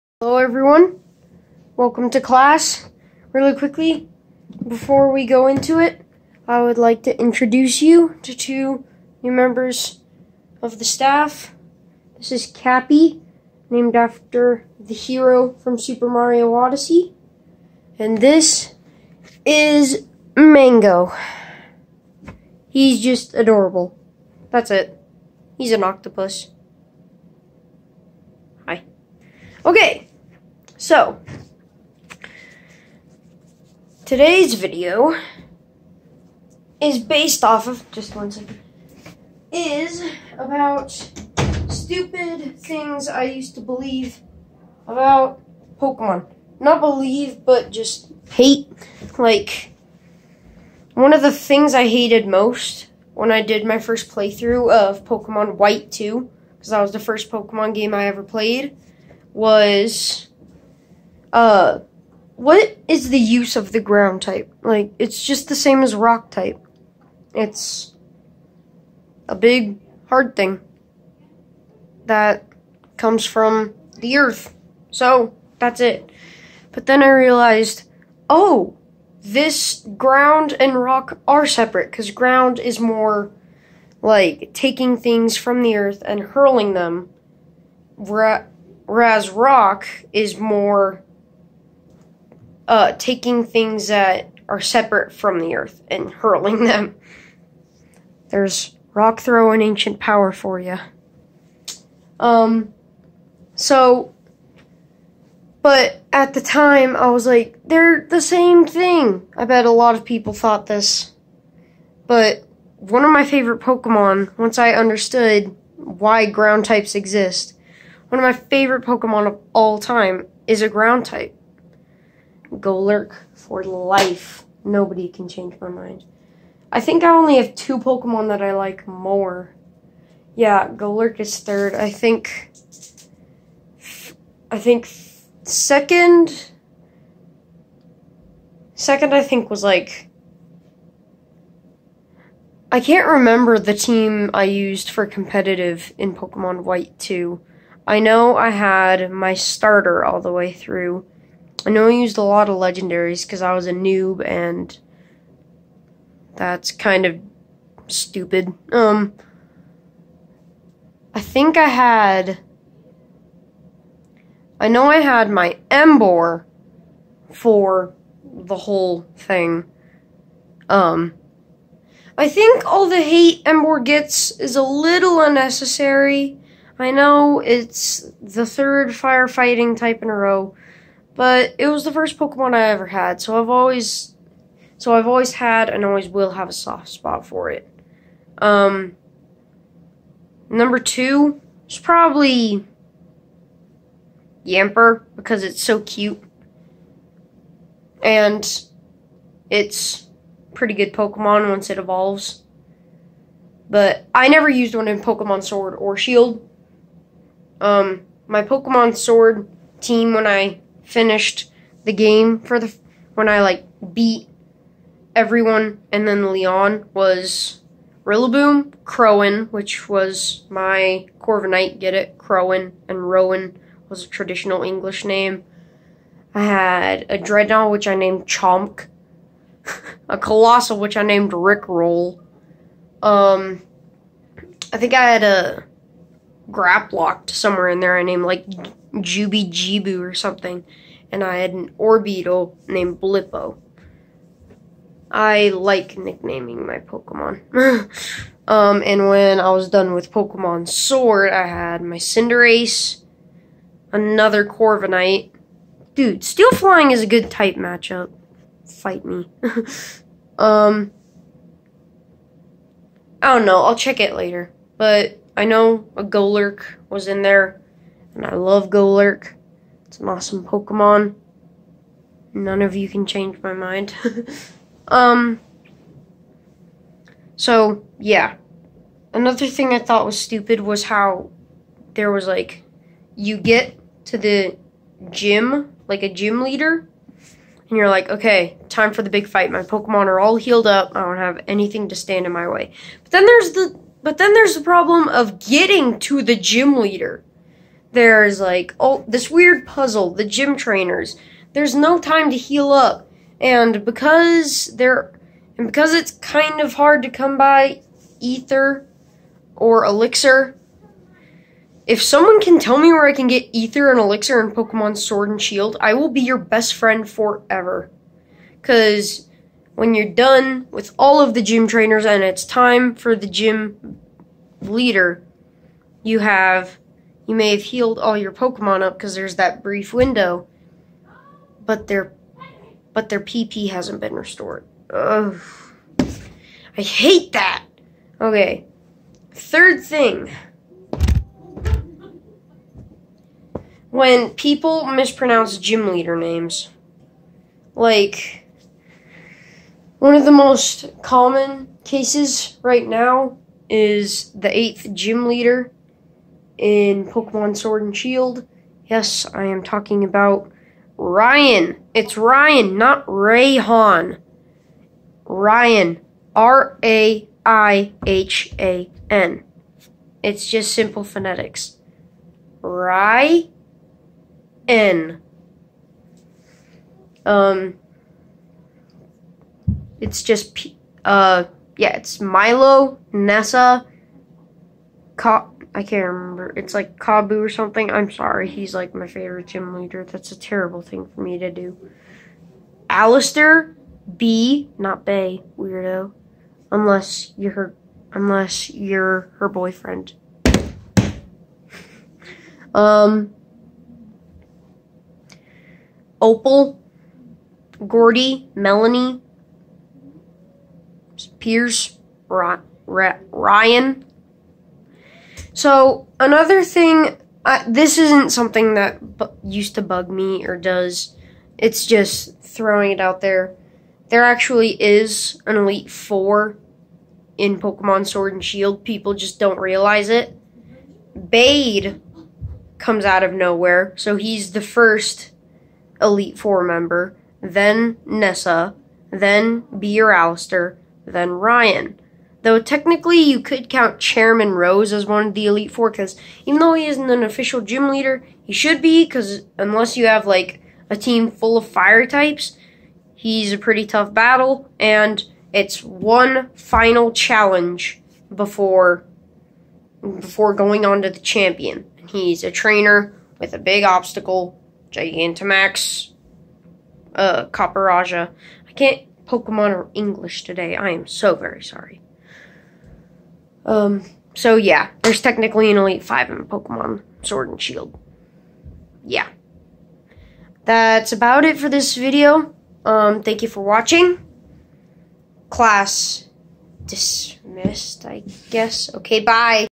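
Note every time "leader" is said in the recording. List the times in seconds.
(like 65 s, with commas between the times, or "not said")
286 s, 296 s, 324 s, 345 s, 355 s, 389 s, 447 s.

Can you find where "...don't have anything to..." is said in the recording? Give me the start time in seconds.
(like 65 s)
291 s.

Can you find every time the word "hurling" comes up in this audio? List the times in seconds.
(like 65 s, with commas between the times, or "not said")
86 s, 96 s.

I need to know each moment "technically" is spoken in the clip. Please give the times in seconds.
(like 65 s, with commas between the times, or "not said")
442 s, 475 s.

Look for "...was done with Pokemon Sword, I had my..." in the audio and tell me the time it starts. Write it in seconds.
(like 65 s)
249 s.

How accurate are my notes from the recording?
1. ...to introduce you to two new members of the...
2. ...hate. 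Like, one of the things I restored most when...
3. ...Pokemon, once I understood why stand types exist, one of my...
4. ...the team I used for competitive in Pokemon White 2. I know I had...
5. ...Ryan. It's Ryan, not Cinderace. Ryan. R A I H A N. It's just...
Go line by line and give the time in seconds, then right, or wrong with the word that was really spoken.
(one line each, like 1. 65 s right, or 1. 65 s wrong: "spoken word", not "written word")
1. 7 s right
2. 48 s wrong: "hated", not "restored"
3. 113 s wrong: "ground", not "stand"
4. 143 s right
5. 360 s wrong: "Rayhan", not "Cinderace".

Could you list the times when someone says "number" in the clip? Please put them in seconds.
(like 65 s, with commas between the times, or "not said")
190 s.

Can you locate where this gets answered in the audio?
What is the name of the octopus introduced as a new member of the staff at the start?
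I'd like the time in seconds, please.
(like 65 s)
20 s.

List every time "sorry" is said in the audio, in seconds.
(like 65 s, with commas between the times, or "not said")
388 s, 471 s.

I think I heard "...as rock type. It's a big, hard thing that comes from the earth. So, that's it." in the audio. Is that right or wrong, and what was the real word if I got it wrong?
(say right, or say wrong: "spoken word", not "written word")
right.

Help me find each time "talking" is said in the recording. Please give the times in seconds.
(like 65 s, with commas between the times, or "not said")
359 s.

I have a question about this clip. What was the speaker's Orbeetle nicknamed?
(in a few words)
Blippo.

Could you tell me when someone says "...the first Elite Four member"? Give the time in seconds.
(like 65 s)
434 s.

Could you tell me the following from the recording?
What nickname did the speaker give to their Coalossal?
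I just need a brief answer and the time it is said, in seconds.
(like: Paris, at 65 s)
Rickroll, at 231 s.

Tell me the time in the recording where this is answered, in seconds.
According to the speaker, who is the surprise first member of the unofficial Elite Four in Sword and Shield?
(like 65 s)
431 s.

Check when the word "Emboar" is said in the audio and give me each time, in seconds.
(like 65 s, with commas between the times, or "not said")
165 s, 173 s.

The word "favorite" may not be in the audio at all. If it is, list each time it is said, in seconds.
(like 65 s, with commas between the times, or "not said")
113 s, 118 s, 389 s.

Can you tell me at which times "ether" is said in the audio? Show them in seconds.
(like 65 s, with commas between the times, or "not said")
308 s, 313 s.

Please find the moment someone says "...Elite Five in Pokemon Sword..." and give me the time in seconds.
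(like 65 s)
475 s.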